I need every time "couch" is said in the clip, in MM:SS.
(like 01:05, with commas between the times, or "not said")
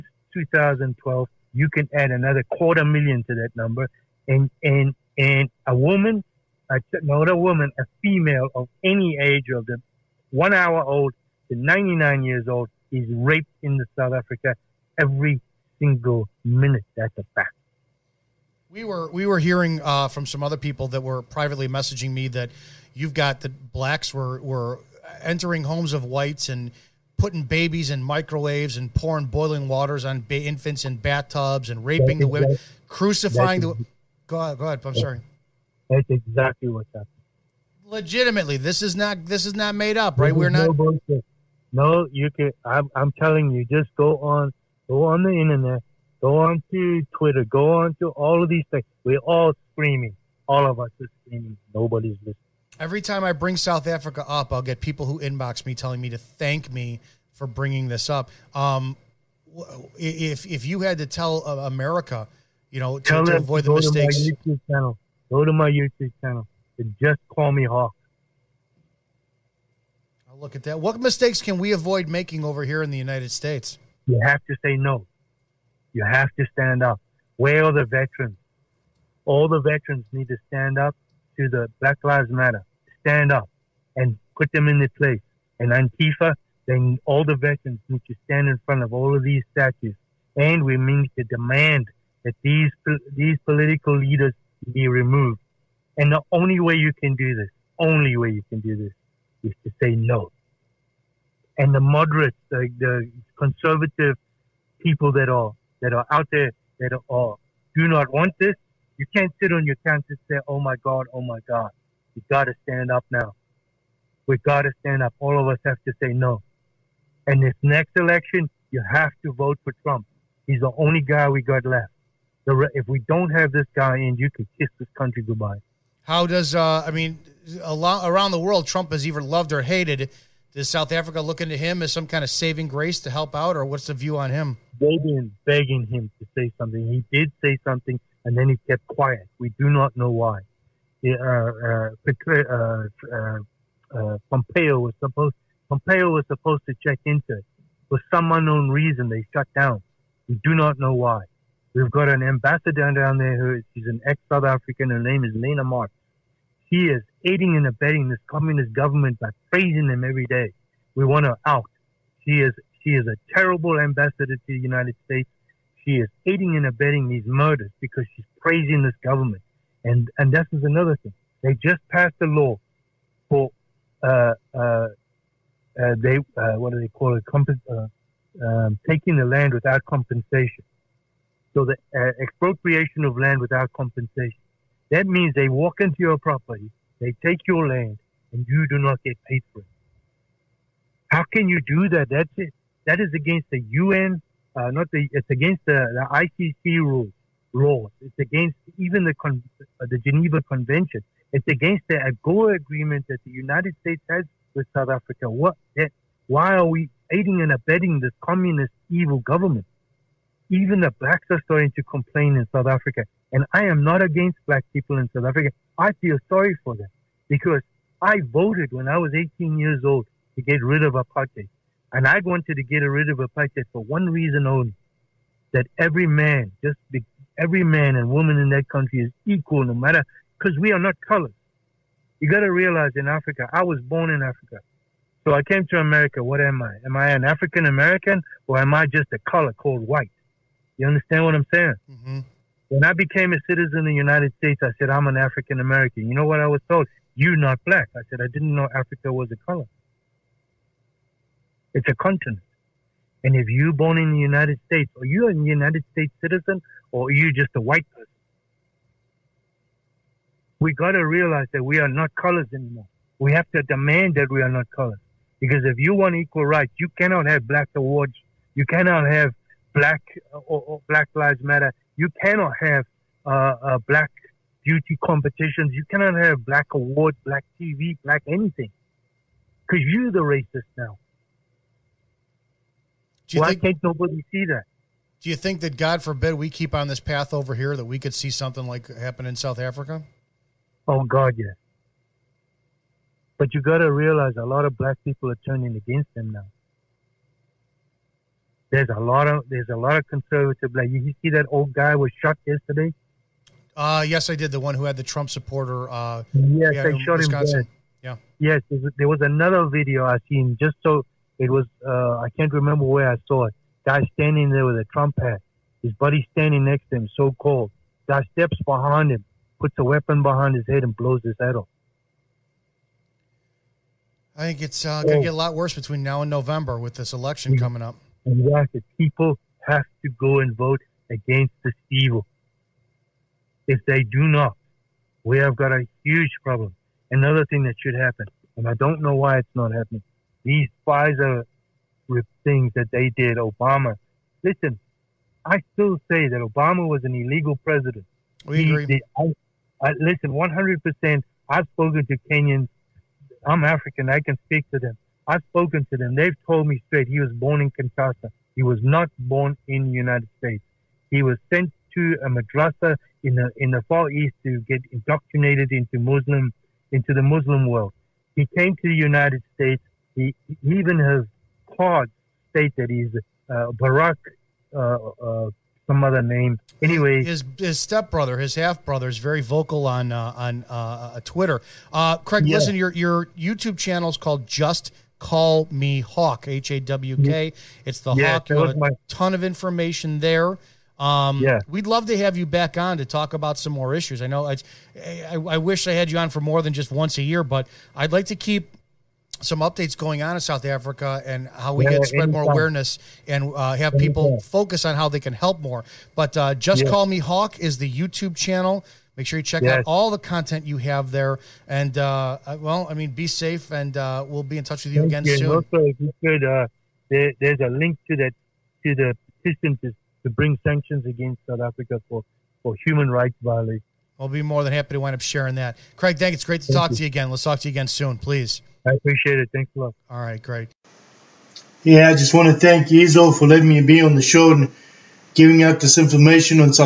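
01:49.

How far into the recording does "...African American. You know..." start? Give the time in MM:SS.
04:05.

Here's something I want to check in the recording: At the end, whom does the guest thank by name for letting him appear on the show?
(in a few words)
Izzo.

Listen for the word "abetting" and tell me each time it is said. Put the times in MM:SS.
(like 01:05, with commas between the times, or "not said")
02:37, 02:46, 03:27.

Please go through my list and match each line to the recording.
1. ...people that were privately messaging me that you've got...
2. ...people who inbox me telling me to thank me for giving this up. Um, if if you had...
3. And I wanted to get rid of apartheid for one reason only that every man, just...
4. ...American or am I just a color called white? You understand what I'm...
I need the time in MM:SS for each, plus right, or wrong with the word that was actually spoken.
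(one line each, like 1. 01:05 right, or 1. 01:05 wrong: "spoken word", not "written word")
1. 00:20 right
2. 00:54 wrong: "bringing", not "giving"
3. 03:41 right
4. 03:57 right.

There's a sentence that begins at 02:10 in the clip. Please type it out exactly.
Does South Africa look into him as some kind of saving grace to help out, or what's the view on him?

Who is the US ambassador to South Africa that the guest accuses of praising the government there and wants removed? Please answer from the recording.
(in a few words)
Lana Marks.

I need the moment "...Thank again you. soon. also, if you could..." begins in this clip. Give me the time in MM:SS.
06:55.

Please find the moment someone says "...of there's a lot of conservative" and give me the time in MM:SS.
04:59.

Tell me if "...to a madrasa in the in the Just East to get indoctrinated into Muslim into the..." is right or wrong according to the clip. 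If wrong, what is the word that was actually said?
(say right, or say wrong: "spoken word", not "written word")
wrong: "Far", not "Just".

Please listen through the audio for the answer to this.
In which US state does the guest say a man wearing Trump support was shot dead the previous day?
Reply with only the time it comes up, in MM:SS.
05:07.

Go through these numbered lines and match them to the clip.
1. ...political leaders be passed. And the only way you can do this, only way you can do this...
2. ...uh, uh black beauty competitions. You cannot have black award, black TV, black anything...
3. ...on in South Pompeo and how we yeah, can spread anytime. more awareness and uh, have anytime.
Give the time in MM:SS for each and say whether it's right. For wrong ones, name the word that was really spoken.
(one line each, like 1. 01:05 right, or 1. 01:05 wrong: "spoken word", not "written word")
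1. 01:33 wrong: "removed", not "passed"
2. 04:33 right
3. 06:40 wrong: "Africa", not "Pompeo".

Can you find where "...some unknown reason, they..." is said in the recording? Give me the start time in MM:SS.
02:28.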